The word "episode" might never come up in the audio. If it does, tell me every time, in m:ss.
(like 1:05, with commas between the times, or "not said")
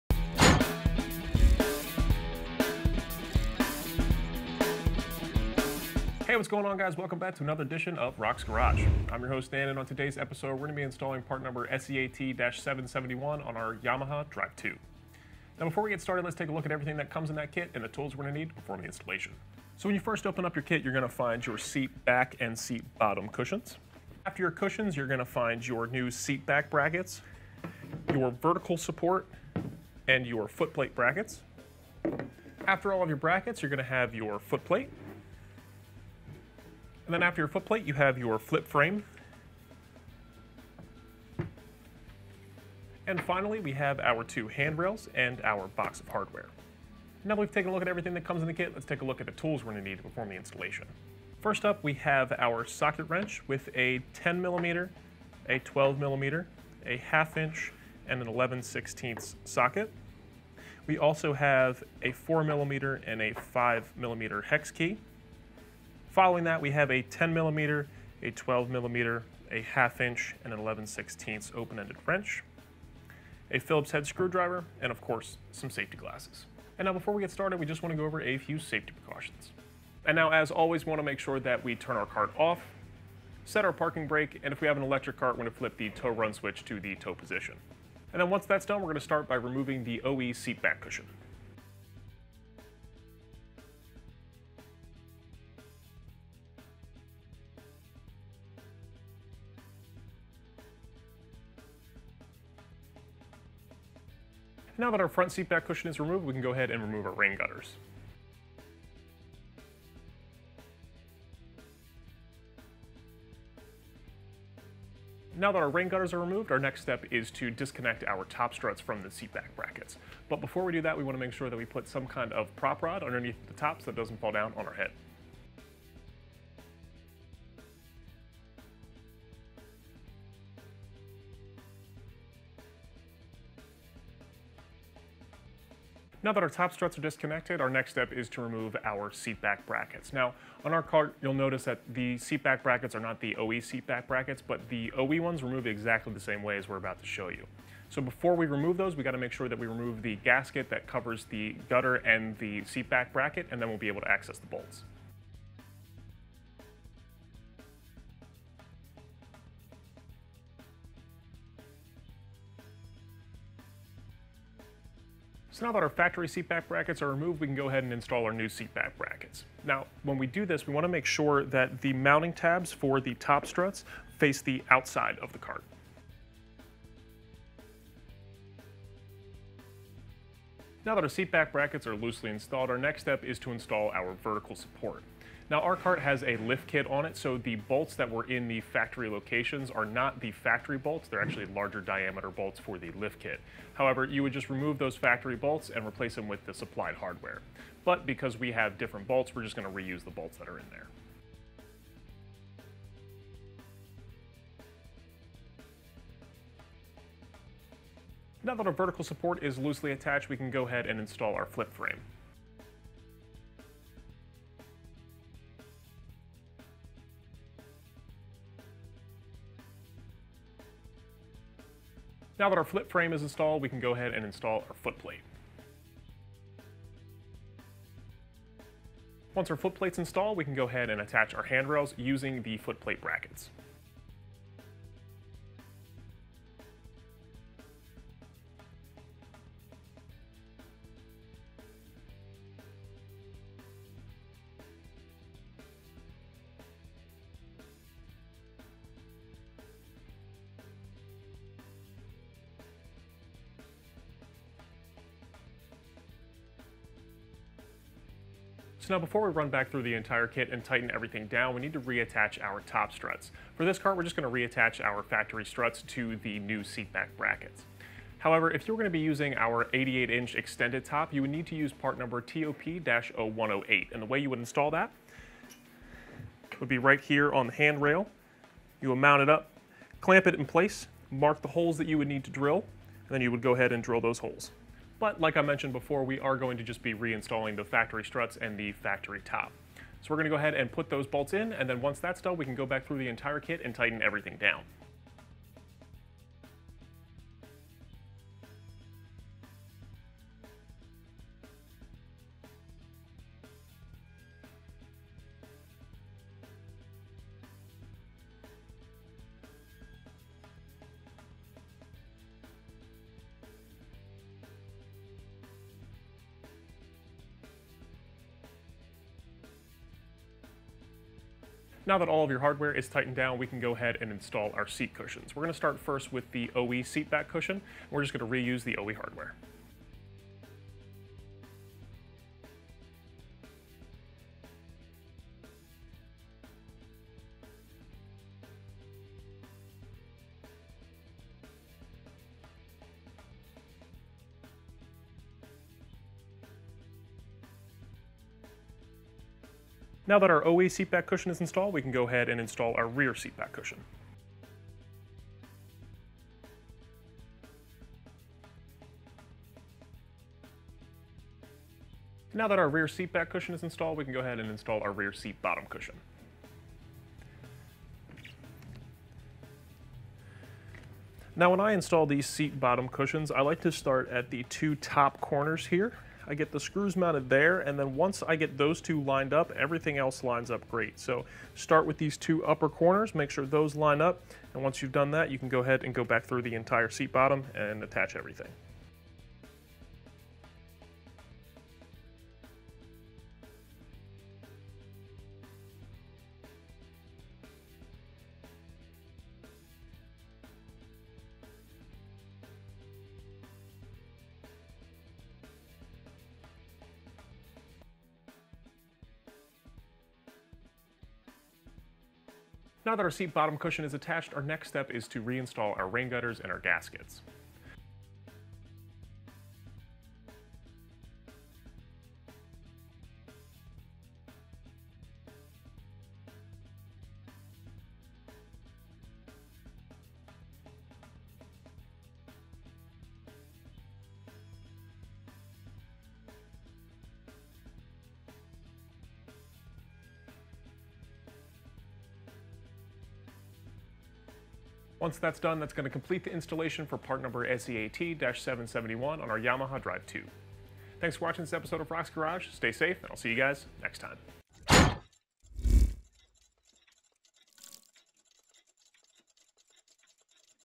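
0:10, 7:31.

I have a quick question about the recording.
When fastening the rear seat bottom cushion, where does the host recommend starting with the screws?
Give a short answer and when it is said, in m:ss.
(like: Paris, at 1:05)
two top corners, at 6:14.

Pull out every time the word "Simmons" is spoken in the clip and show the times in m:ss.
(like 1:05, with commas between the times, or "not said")
not said.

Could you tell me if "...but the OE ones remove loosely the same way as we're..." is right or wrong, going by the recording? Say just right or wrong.
wrong.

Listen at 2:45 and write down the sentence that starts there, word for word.
So now that our factory seatback brackets are removed, we can go ahead and install our new seatback brackets.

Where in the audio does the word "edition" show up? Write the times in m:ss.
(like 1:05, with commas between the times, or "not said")
0:07.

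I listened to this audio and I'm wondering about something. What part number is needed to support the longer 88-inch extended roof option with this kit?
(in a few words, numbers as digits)
TOP-0108.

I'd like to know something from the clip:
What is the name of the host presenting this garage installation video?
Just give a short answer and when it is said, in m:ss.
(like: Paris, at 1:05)
Dan, at 0:09.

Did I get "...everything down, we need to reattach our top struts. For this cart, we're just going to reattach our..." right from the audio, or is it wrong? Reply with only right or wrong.
right.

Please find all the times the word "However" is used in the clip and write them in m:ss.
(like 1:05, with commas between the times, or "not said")
3:13, 4:28.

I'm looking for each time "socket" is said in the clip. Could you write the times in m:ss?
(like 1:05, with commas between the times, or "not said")
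0:52, 0:59.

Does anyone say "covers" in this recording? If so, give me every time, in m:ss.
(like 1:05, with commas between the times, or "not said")
2:30.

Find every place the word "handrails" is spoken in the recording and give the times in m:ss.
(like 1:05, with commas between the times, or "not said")
0:44, 3:51, 4:37.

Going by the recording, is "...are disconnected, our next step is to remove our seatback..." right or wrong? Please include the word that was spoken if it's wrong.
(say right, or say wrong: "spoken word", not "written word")
right.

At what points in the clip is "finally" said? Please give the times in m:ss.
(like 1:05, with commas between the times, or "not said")
0:43.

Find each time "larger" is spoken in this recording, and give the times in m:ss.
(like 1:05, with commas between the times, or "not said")
3:11.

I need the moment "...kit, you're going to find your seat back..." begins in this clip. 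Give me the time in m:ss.
0:20.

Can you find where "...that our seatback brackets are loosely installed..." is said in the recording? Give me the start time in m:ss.
3:00.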